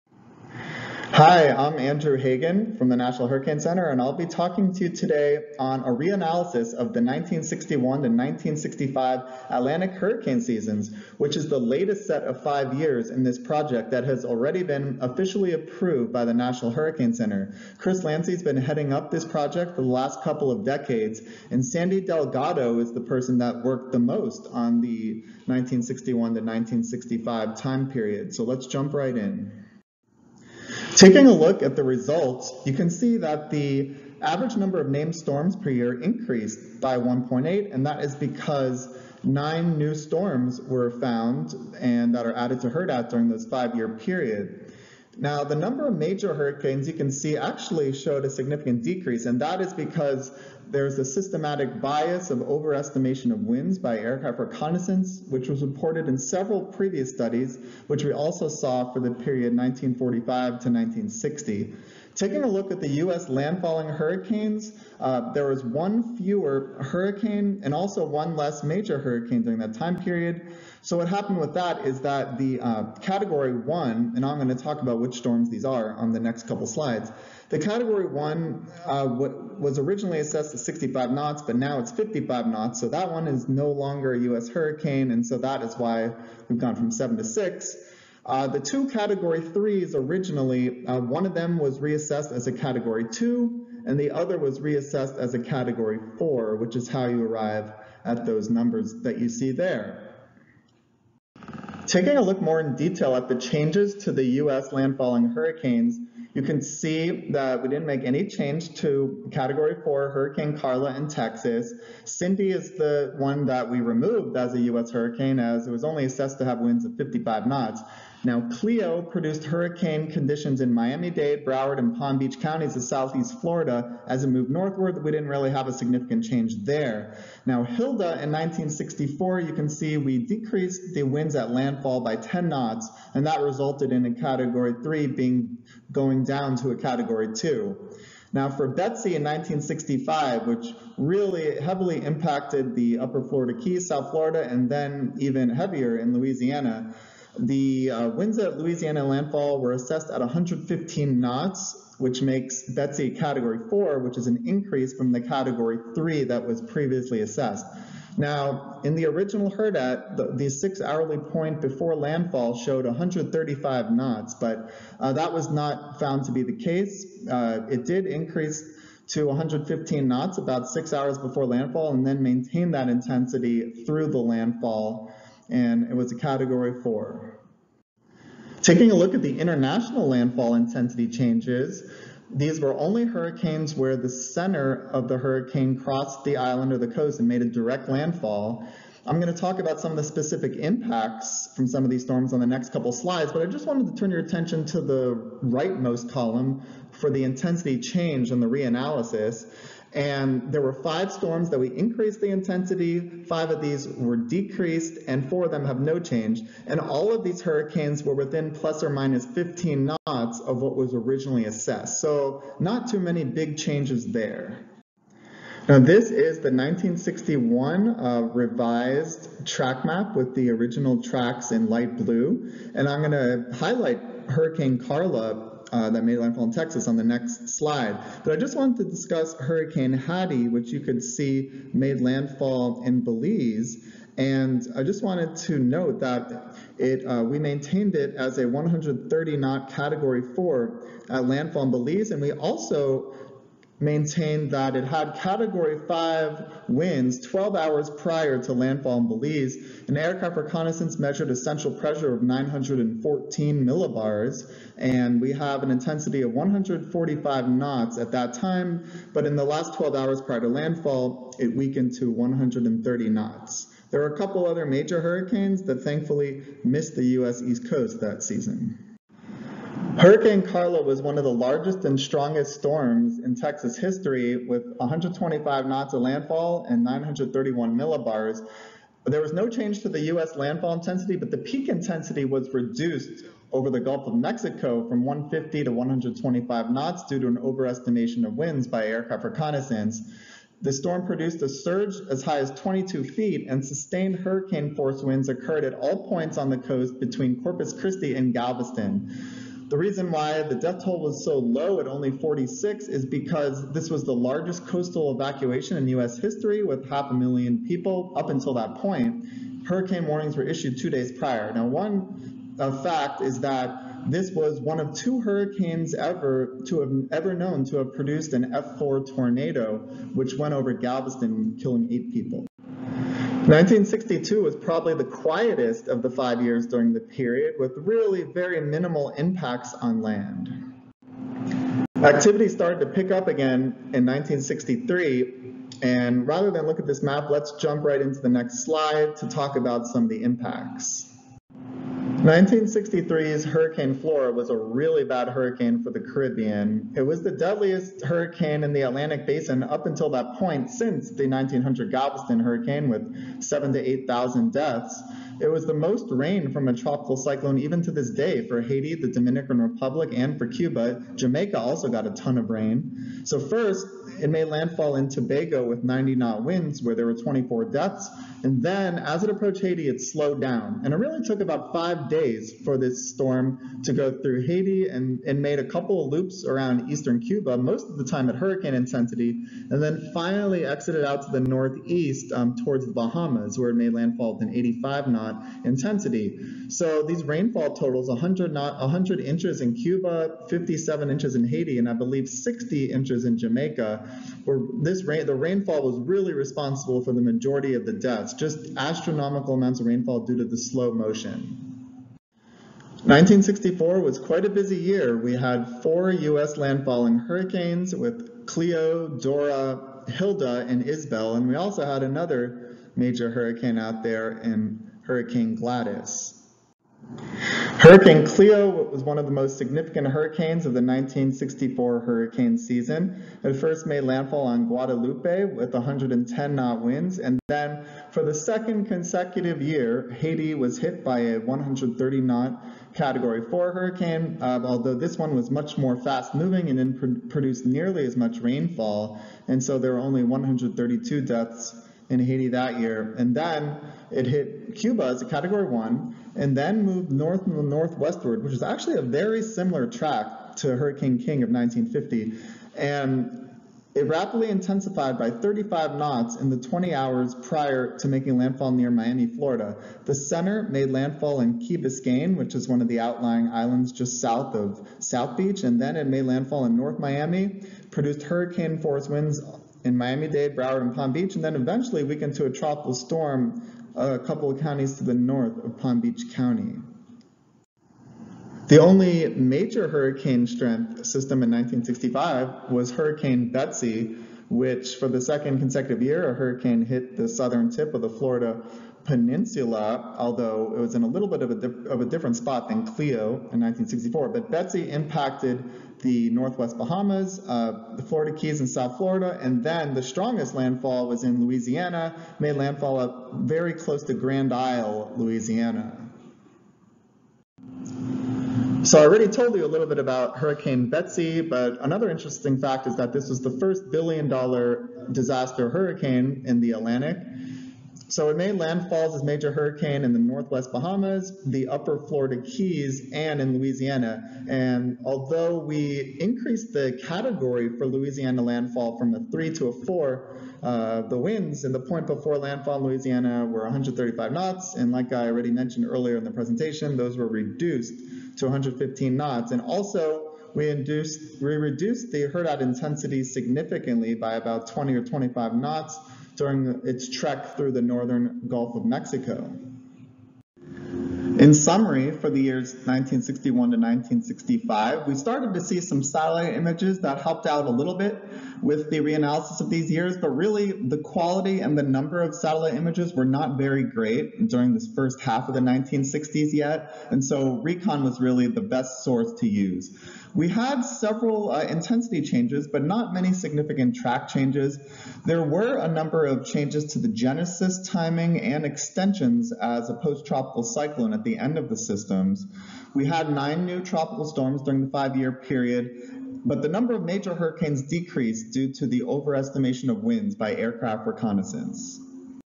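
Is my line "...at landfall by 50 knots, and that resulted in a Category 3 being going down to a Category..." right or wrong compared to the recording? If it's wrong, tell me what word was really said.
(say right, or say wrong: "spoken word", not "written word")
wrong: "10", not "50".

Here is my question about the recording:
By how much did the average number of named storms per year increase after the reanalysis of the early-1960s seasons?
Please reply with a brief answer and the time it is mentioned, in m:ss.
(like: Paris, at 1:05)
1.8, at 0:36.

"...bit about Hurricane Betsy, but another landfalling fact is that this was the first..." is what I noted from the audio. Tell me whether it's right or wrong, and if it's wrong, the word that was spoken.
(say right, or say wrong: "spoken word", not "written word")
wrong: "interesting", not "landfalling".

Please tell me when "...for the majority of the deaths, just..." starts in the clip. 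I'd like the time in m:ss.
6:37.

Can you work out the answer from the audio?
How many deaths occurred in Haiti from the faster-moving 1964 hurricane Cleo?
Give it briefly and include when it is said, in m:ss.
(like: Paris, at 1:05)
132, at 7:20.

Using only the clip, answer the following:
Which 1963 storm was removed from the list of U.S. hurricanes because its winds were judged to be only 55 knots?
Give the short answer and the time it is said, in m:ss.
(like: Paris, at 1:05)
Cindy, at 1:52.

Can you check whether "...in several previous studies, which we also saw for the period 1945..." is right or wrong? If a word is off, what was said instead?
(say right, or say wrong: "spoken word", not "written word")
right.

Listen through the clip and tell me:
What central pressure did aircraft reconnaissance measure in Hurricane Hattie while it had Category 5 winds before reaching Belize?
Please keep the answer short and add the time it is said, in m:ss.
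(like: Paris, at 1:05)
914 millibars, at 4:12.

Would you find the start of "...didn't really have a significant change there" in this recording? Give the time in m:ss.
2:05.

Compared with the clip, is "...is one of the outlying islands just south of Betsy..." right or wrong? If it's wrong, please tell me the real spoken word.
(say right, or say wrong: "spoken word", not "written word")
wrong: "South", not "Betsy".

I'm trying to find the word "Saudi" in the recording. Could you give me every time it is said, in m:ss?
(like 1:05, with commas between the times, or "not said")
not said.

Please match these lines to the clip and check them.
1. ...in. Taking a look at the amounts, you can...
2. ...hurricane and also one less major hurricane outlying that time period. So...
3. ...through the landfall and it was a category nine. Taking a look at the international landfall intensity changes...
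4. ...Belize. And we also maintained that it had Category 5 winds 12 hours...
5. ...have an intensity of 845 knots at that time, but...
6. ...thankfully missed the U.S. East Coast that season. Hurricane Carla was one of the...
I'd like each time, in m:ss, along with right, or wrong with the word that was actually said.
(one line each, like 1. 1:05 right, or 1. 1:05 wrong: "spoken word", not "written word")
1. 0:29 wrong: "results", not "amounts"
2. 1:06 wrong: "during", not "outlying"
3. 2:53 wrong: "four", not "nine"
4. 4:01 right
5. 4:15 wrong: "145", not "845"
6. 4:25 right.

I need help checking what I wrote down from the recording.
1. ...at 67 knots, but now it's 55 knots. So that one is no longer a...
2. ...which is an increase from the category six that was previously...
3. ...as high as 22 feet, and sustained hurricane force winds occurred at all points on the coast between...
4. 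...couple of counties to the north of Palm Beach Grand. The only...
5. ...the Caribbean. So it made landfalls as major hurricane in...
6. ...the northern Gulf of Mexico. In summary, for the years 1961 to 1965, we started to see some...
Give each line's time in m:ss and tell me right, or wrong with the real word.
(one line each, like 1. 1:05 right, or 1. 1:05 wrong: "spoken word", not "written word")
1. 1:20 wrong: "65", not "67"
2. 2:33 wrong: "three", not "six"
3. 4:52 right
4. 7:54 wrong: "County", not "Grand"
5. 8:36 wrong: "Atlantic", not "Caribbean"
6. 9:07 right.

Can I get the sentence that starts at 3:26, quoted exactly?
And all of these hurricanes were within plus or minus 15 knots of what was originally assessed.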